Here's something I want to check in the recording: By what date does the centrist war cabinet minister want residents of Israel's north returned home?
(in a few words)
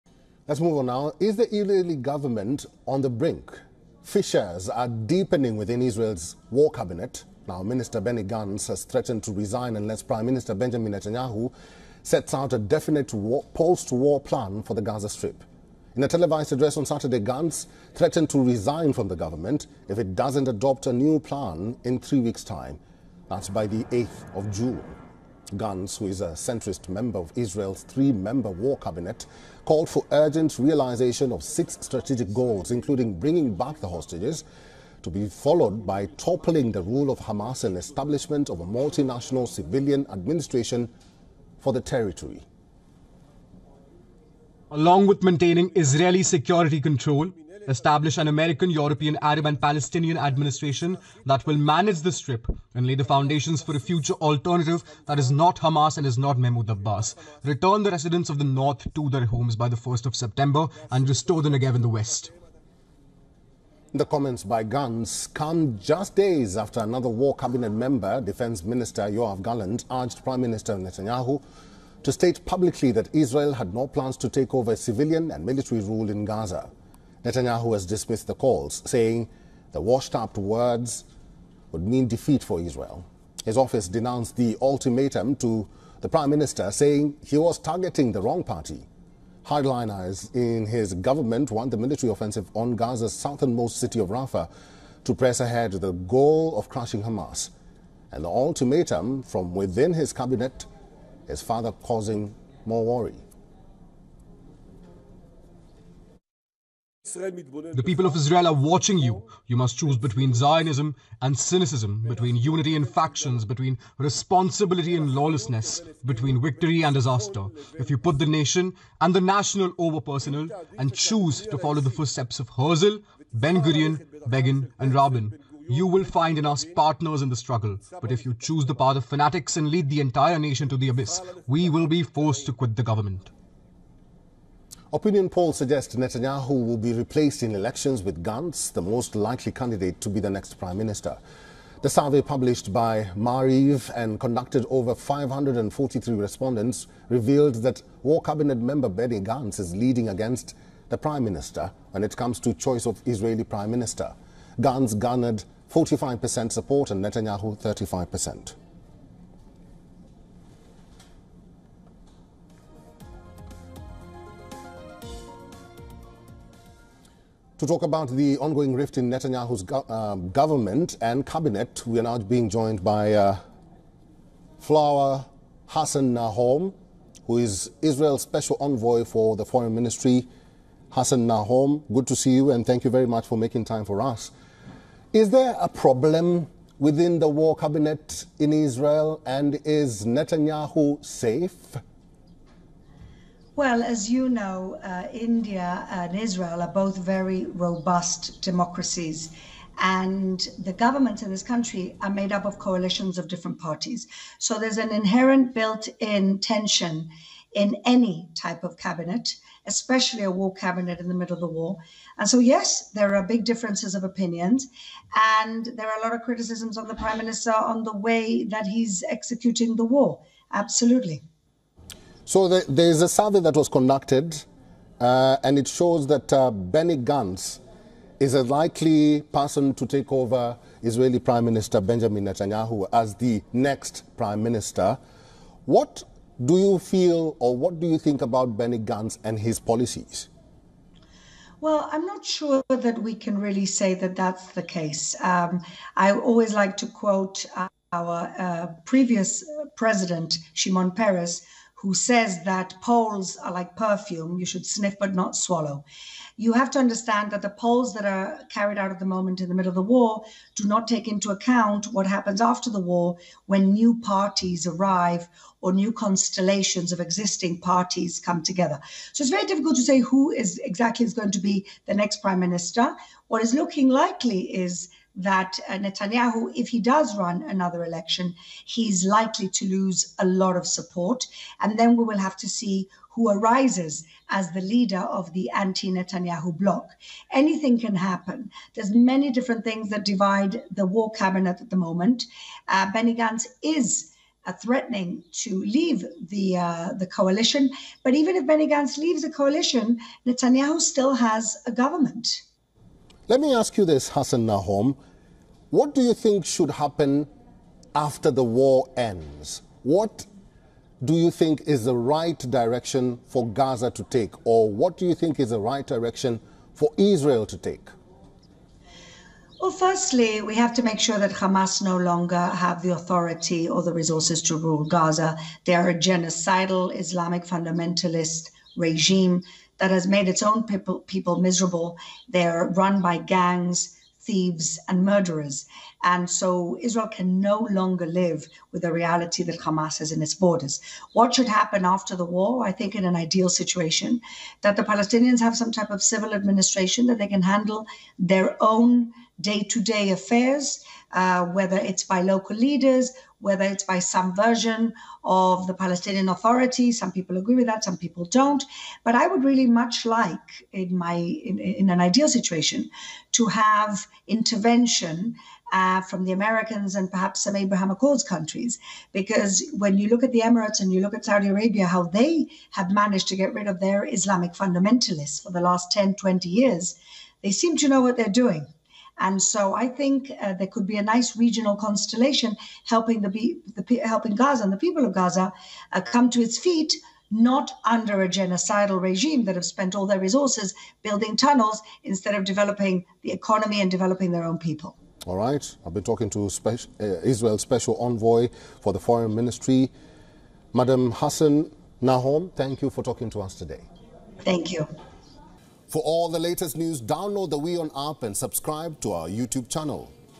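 1st of September.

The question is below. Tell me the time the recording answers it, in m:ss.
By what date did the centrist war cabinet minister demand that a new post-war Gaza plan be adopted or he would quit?
0:23.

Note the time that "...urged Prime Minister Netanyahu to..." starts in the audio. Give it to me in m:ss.
1:09.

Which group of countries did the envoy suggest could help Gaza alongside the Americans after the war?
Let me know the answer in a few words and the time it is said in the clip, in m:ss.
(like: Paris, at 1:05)
Abraham Accords countries, at 6:07.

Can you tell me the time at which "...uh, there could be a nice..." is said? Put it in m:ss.
6:20.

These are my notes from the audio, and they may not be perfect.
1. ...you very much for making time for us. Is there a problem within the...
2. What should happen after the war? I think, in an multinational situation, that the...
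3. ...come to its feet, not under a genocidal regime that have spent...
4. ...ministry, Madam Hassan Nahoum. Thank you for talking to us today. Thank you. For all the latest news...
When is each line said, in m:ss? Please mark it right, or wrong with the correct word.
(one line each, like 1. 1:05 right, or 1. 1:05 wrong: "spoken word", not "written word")
1. 3:02 right
2. 5:41 wrong: "ideal", not "multinational"
3. 6:26 right
4. 6:39 right.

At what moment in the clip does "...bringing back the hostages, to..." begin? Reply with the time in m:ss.
0:33.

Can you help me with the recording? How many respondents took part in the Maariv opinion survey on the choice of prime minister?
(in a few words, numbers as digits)
543.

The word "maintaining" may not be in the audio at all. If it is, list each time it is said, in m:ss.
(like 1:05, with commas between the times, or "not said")
0:45.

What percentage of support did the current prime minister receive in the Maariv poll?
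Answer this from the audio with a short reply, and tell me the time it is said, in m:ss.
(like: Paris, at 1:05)
35%, at 2:37.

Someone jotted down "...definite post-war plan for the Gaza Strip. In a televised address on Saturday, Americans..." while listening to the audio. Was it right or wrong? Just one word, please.
wrong.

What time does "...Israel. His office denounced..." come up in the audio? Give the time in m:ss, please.
1:22.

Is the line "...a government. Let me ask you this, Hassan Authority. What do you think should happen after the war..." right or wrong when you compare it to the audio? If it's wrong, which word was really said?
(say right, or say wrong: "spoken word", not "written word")
wrong: "Nahoum", not "Authority".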